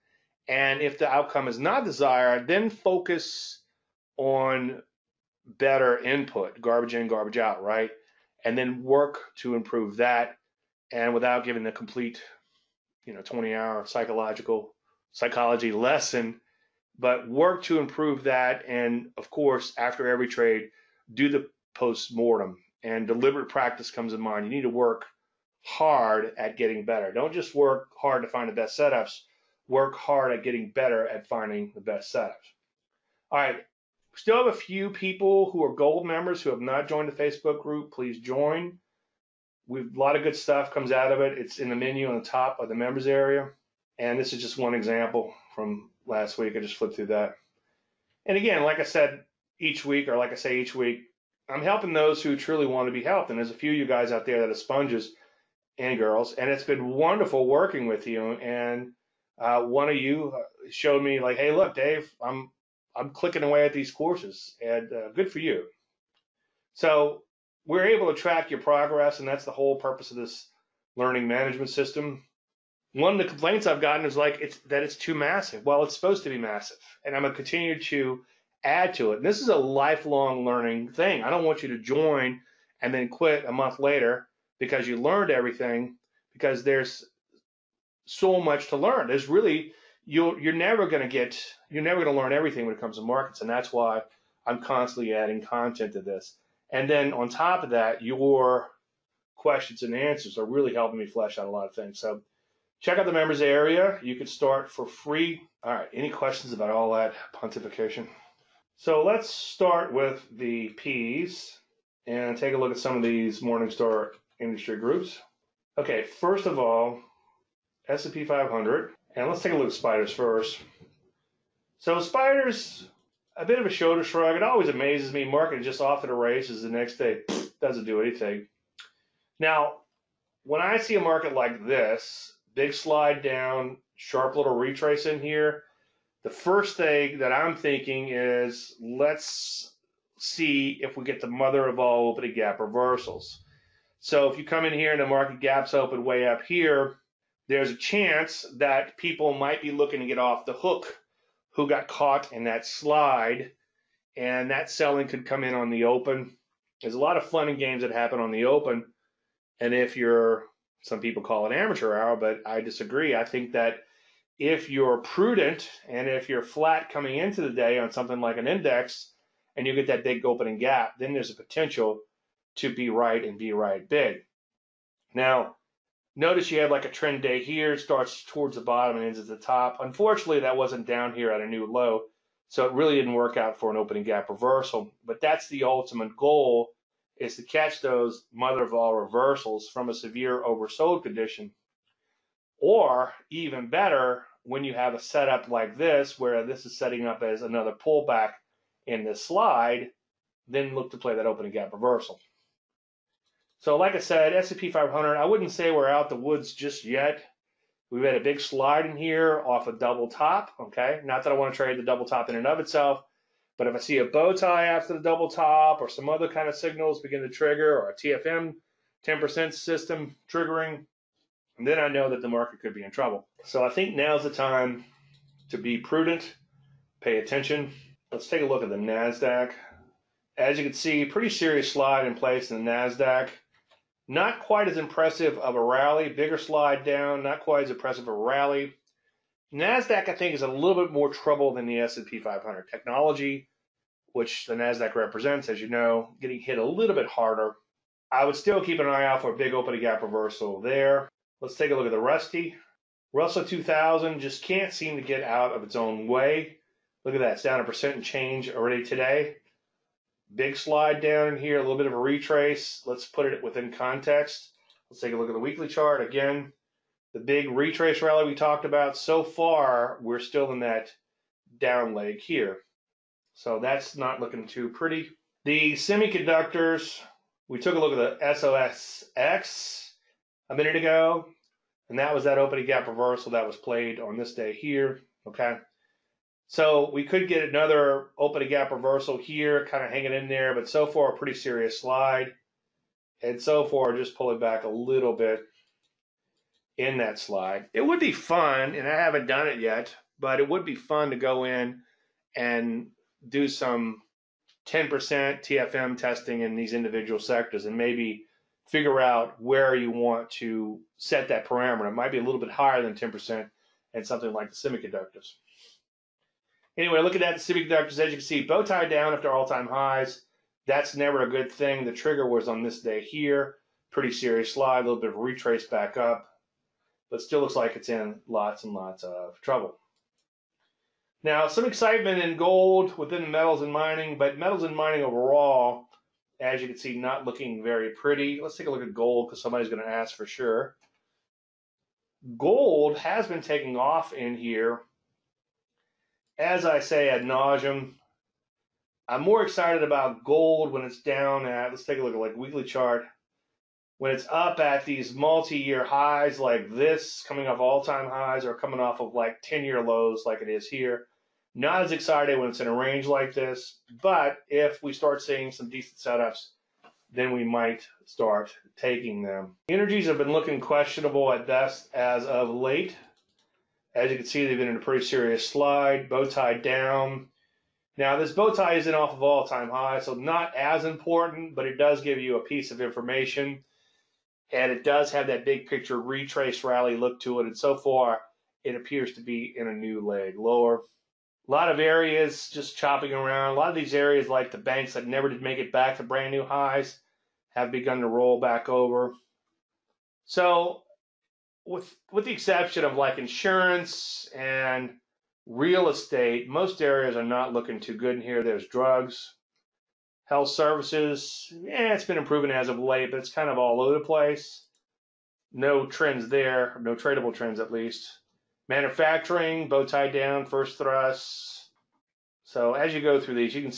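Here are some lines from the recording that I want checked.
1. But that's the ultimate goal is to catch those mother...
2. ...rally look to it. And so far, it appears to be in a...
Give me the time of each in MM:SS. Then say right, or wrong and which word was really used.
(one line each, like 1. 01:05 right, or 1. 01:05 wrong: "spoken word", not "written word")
1. 03:05 right
2. 06:26 right.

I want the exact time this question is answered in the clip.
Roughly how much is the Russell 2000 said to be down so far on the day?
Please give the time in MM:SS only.
04:17.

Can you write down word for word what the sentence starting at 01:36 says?
And then on top of that, your questions and answers are really helping me flesh out a lot of things.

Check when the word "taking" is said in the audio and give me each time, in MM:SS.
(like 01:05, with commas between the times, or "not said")
05:43, 06:08.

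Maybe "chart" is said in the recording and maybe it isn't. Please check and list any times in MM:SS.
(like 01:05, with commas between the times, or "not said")
04:25, 05:52.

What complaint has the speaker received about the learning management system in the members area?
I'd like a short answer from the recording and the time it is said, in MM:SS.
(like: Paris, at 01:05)
Too massive, at 01:14.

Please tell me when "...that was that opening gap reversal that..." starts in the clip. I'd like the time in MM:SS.
04:41.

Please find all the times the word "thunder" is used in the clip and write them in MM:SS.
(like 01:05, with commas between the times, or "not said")
not said.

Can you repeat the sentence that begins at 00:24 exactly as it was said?
You need to work hard at getting better.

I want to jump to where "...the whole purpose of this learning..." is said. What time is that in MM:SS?
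01:09.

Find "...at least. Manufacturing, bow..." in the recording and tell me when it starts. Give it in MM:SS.
06:57.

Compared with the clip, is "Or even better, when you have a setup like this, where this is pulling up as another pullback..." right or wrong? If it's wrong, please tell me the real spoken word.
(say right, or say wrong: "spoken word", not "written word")
wrong: "setting", not "pulling".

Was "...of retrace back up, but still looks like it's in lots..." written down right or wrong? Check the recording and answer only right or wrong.
right.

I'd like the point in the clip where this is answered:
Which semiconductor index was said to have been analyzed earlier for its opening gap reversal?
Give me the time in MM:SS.
04:38.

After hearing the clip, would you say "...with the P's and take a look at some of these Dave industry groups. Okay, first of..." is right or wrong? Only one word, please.
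wrong.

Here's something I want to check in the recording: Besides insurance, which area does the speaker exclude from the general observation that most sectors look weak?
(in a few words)
Real estate.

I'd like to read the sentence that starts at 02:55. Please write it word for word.
Now, Notice you have like a trend day here, starts towards the bottom and ends at the top.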